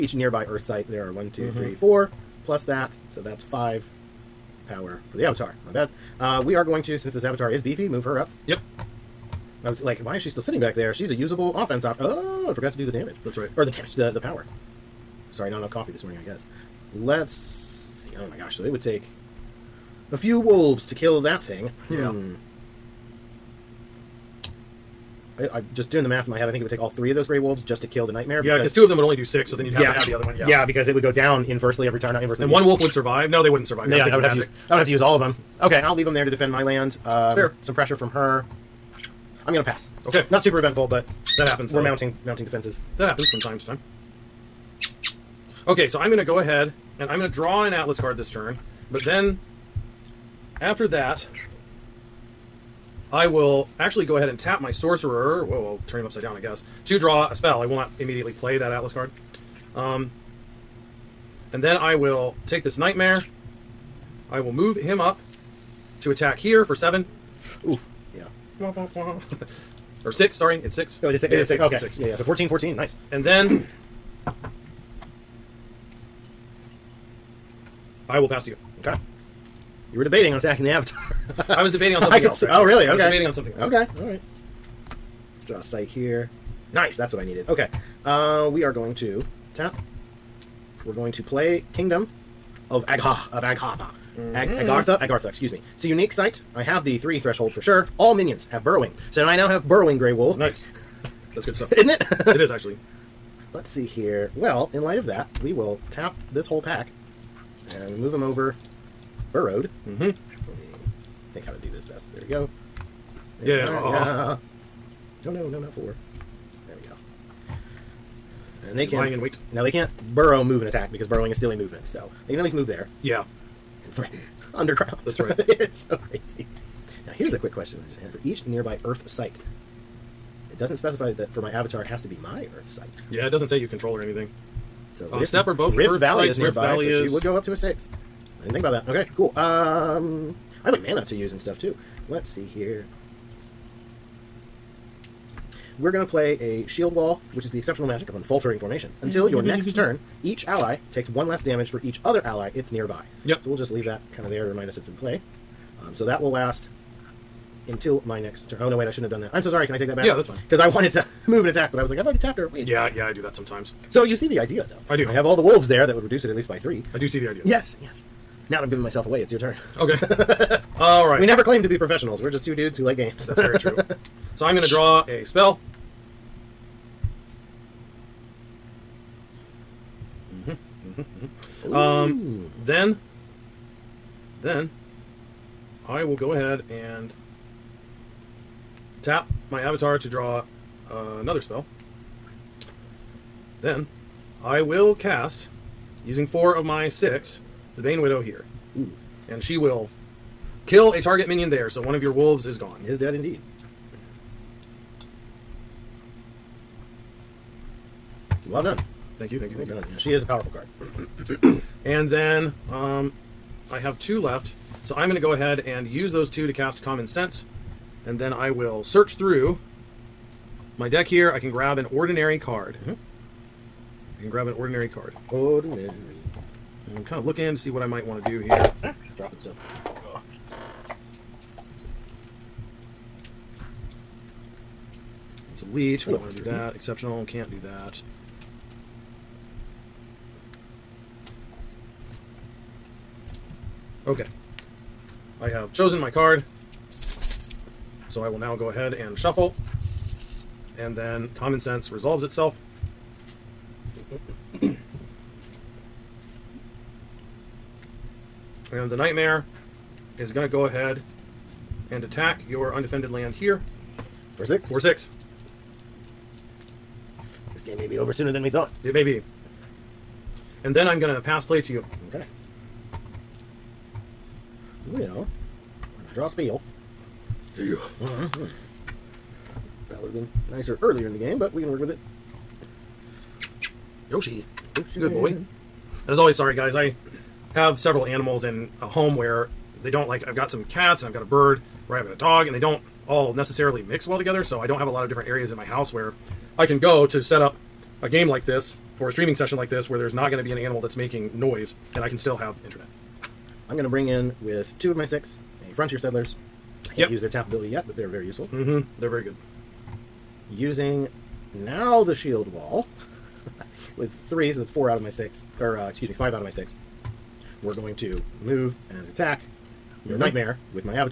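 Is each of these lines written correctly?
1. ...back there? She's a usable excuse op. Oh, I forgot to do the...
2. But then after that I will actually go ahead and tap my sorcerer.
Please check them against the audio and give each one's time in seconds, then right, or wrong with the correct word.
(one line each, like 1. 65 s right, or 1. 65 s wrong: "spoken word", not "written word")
1. 10 s wrong: "offense", not "excuse"
2. 48 s right.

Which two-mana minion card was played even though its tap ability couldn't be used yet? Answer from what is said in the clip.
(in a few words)
Frontier Settlers.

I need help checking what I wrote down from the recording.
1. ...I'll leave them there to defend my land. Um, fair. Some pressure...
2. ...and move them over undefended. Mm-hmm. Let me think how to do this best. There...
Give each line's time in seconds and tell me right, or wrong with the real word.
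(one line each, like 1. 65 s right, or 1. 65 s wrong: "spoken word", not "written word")
1. 35 s right
2. 107 s wrong: "burrowed", not "undefended".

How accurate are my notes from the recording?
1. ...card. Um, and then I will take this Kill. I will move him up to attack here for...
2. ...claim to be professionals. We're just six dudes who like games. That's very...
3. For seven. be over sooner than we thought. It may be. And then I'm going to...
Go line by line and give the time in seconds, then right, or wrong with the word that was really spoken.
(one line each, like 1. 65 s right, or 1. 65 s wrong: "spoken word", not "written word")
1. 58 s wrong: "Nightmare", not "Kill"
2. 171 s wrong: "two", not "six"
3. 264 s wrong: "six", not "seven".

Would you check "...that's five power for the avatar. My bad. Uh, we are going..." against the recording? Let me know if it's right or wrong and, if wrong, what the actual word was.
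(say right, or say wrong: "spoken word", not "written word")
right.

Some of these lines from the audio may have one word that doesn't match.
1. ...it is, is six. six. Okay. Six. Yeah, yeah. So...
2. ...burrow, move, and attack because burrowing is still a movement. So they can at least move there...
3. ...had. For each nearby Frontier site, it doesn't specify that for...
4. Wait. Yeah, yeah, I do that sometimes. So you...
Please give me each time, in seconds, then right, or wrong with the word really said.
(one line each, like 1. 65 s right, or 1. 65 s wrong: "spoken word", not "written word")
1. 71 s right
2. 120 s right
3. 127 s wrong: "Earth", not "Frontier"
4. 162 s right.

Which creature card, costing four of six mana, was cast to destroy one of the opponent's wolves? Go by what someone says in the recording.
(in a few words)
Bane Widow.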